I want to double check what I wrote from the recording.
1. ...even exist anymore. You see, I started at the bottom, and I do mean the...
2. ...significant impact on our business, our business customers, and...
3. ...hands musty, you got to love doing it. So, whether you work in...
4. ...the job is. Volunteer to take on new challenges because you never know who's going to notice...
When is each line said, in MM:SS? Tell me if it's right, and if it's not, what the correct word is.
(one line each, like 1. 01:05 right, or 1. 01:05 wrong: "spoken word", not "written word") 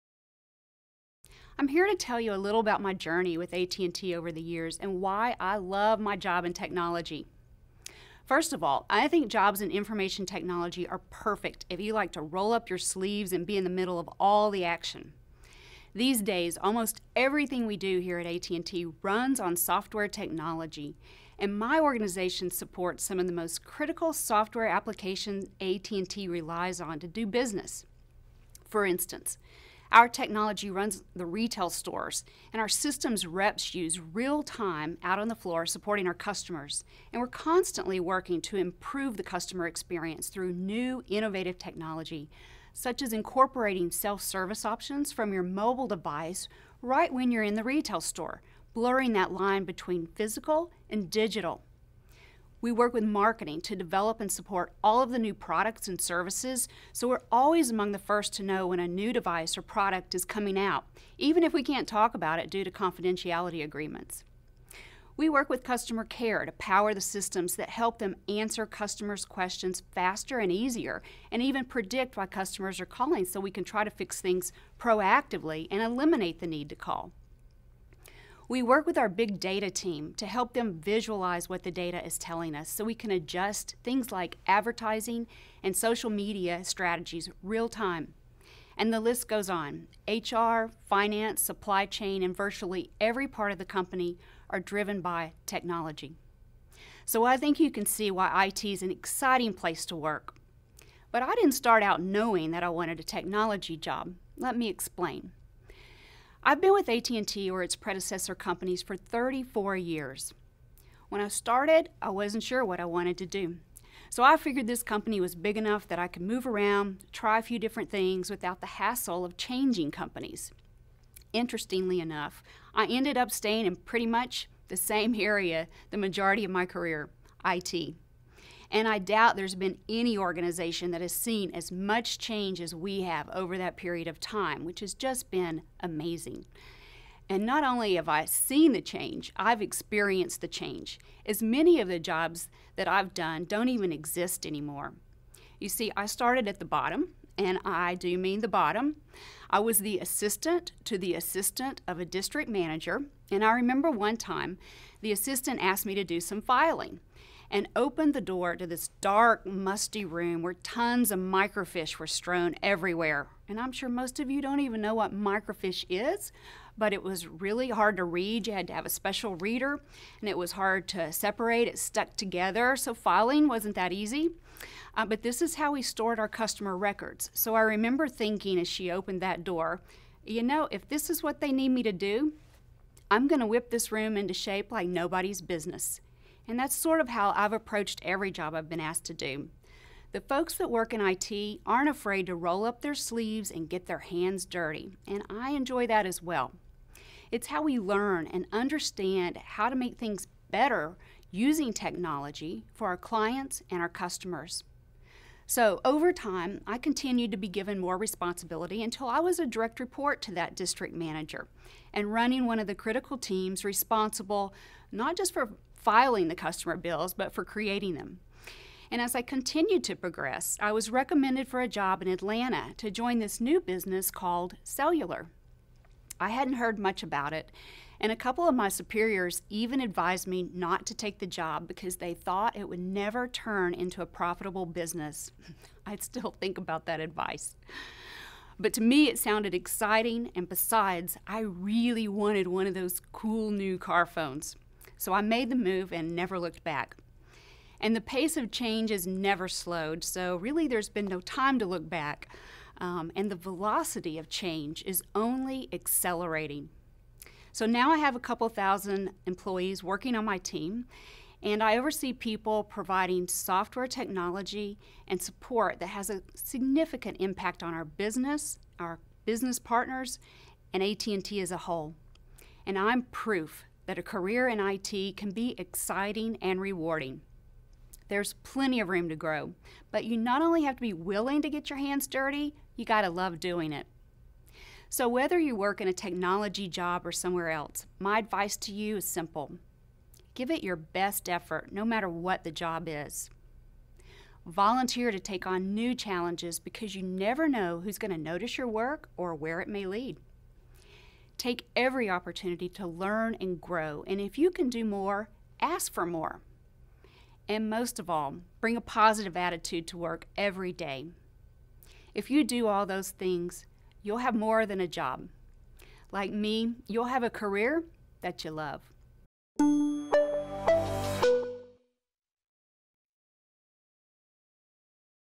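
1. 02:23 right
2. 04:26 wrong: "partners", not "customers"
3. 04:41 wrong: "dirty", not "musty"
4. 04:52 right.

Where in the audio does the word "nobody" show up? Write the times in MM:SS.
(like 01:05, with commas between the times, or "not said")
03:04.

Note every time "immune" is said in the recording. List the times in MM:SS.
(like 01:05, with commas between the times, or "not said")
not said.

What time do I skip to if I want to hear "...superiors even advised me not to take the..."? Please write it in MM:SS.
03:48.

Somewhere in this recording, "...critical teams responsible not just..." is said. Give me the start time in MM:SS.
03:32.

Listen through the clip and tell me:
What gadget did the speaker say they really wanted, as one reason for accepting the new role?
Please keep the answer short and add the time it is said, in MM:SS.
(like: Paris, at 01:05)
car phones, at 04:03.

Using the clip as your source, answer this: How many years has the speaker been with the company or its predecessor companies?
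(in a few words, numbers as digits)
34.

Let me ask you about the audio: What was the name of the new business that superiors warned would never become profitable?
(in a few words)
Cellular.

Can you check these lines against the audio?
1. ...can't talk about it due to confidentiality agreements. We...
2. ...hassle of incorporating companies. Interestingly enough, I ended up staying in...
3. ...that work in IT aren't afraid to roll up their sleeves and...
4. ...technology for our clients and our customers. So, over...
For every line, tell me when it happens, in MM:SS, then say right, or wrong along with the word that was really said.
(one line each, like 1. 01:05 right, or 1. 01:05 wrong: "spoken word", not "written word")
1. 01:01 right
2. 01:58 wrong: "changing", not "incorporating"
3. 03:10 right
4. 03:21 right.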